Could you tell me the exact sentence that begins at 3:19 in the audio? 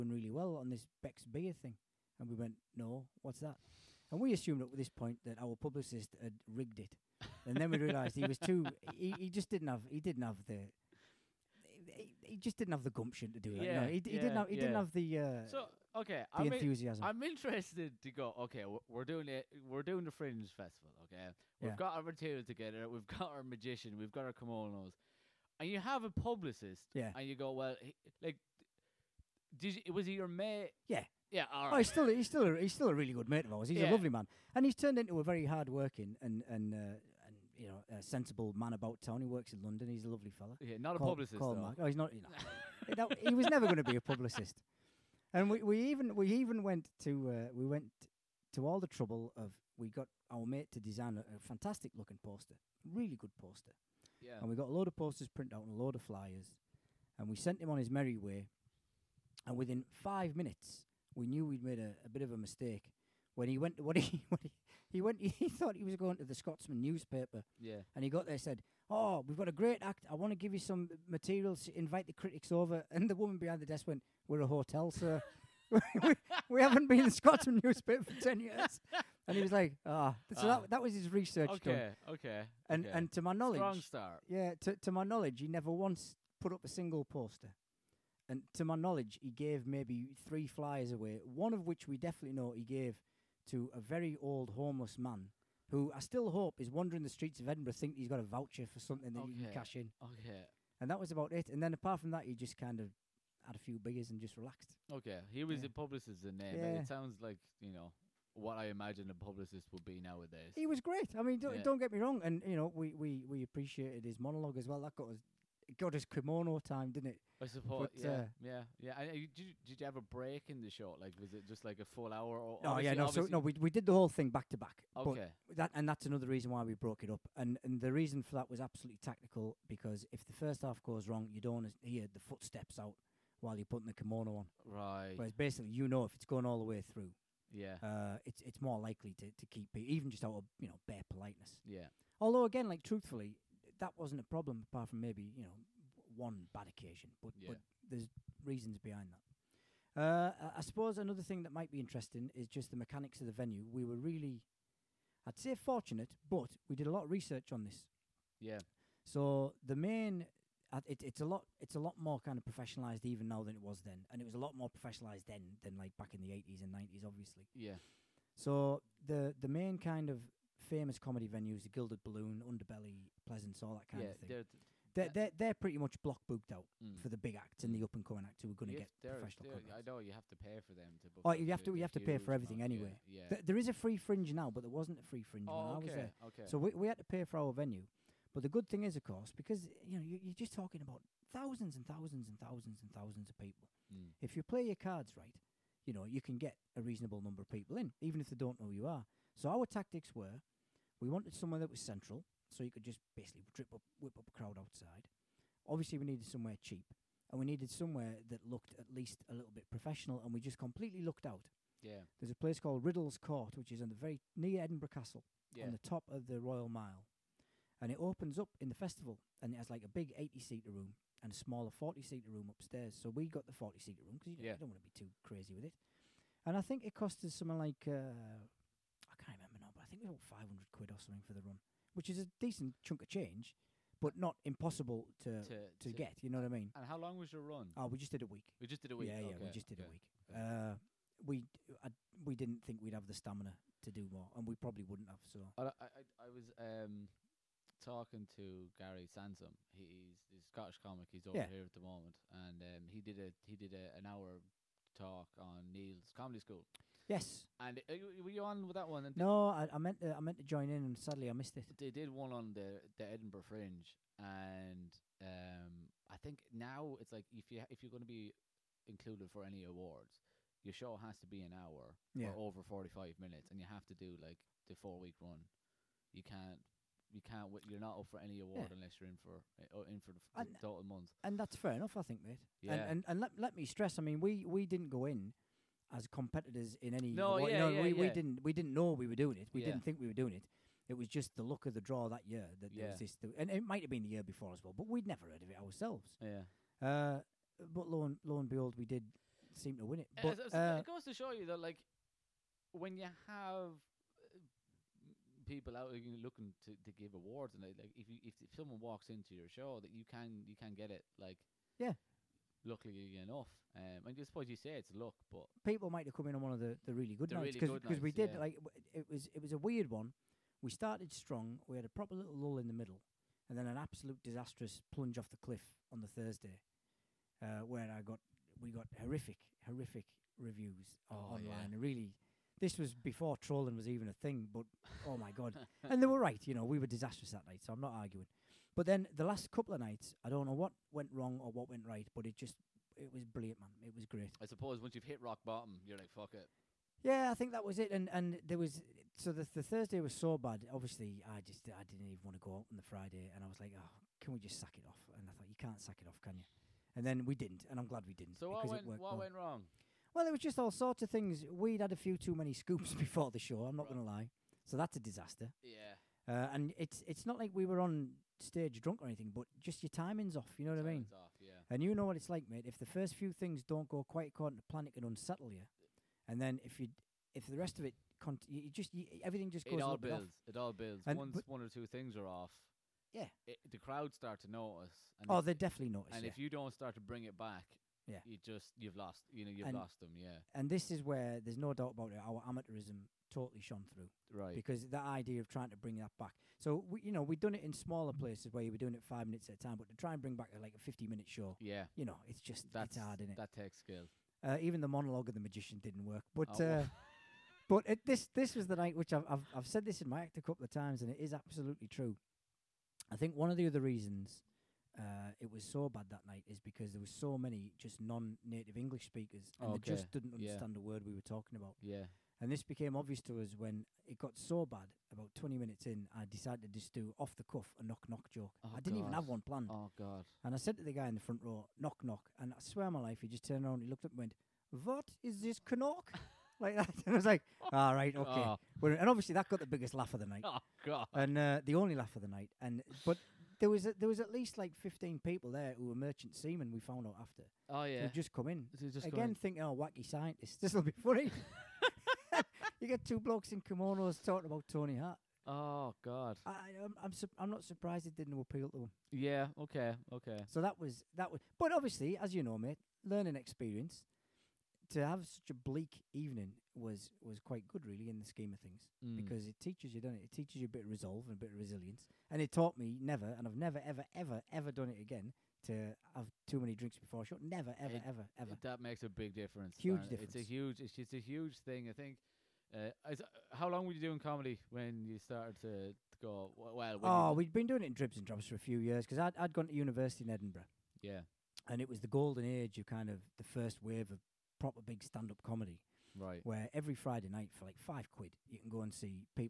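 So our tactics were we wanted somewhere that was central, so you could just basically up, whip up a crowd outside.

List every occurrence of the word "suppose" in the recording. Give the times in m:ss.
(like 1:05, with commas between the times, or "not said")
1:57, 2:30, 5:14, 5:44.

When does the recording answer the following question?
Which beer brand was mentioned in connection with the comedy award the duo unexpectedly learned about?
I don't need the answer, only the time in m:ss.
0:01.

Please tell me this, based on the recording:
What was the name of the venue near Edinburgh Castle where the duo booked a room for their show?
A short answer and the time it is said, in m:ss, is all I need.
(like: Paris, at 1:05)
Riddle's Court, at 3:32.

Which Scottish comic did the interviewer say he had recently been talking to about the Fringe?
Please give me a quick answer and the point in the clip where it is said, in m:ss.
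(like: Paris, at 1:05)
Gary Sansom, at 4:08.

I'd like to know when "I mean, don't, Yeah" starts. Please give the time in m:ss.
1:51.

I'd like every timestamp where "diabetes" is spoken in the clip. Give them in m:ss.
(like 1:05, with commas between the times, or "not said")
not said.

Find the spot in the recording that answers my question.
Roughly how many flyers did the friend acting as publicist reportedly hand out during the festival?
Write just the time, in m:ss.
1:30.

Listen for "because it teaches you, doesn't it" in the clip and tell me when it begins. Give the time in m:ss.
7:49.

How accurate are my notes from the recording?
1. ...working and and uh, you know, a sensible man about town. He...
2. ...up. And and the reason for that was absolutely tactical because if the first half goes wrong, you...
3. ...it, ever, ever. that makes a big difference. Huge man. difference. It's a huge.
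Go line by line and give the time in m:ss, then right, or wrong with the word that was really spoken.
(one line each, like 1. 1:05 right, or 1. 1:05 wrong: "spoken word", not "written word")
1. 0:35 right
2. 2:07 right
3. 7:57 right.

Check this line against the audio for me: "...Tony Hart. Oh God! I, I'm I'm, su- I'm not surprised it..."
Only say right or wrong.
right.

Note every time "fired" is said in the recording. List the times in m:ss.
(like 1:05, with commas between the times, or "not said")
not said.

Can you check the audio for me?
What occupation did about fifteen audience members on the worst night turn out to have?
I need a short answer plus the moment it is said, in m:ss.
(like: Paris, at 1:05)
Merchant seamen, at 7:25.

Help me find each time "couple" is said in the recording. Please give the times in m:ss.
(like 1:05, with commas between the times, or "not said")
5:39, 6:50.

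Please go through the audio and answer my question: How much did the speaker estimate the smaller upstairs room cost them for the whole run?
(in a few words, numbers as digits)
500 quid.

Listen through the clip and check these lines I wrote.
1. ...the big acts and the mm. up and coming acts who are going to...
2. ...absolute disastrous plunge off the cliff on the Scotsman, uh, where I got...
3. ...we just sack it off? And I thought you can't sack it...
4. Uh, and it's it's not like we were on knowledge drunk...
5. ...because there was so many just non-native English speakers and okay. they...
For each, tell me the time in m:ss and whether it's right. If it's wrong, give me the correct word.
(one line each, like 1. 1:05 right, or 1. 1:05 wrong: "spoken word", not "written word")
1. 2:57 right
2. 5:23 wrong: "Thursday", not "Scotsman"
3. 5:54 right
4. 6:06 wrong: "stage", not "knowledge"
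5. 6:56 right.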